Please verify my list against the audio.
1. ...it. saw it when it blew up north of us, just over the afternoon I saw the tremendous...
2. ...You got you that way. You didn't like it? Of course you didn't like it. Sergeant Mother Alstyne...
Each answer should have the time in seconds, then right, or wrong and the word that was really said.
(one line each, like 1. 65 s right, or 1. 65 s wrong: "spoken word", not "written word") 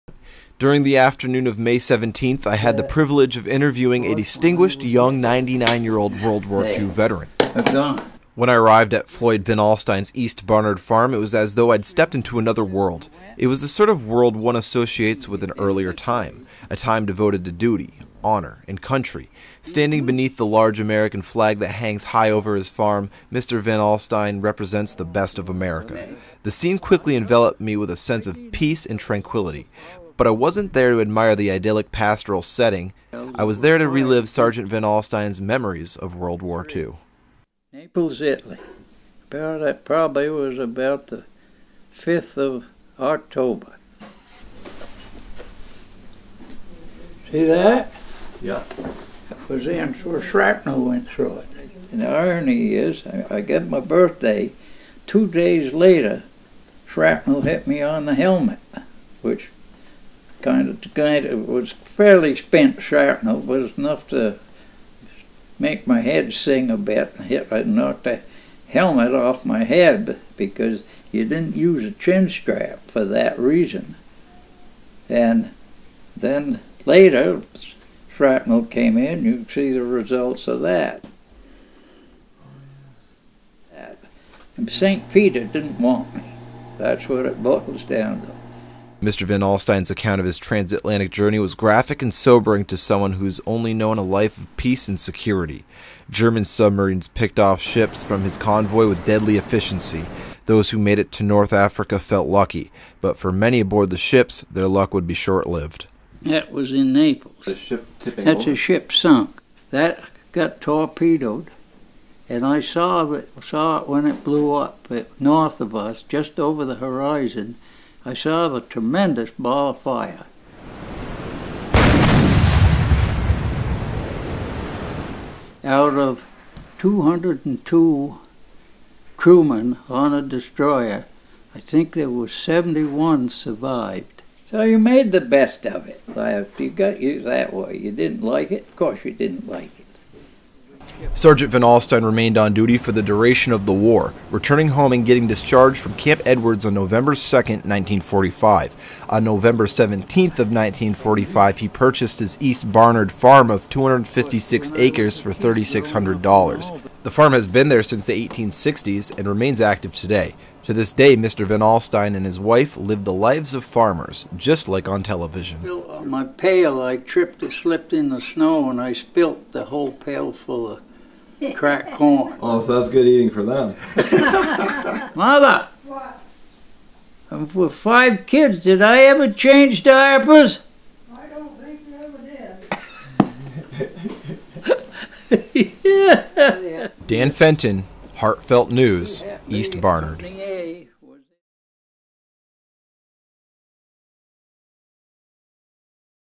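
1. 113 s wrong: "horizon", not "afternoon"
2. 136 s wrong: "Van", not "Mother".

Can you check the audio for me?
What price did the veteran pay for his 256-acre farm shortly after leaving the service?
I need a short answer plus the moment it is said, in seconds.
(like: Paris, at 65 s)
$3,600, at 155 s.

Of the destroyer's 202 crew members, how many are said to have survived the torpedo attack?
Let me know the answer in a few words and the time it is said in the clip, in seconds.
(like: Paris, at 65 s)
71, at 132 s.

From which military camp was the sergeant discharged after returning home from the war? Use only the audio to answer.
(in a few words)
Camp Edwards.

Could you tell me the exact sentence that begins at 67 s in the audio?
Hit, I uh, knocked a helmet off my head because you didn't use a chin strap for that reason.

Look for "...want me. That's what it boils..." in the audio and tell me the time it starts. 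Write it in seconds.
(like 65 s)
85 s.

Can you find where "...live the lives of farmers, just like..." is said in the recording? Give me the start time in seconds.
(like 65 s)
162 s.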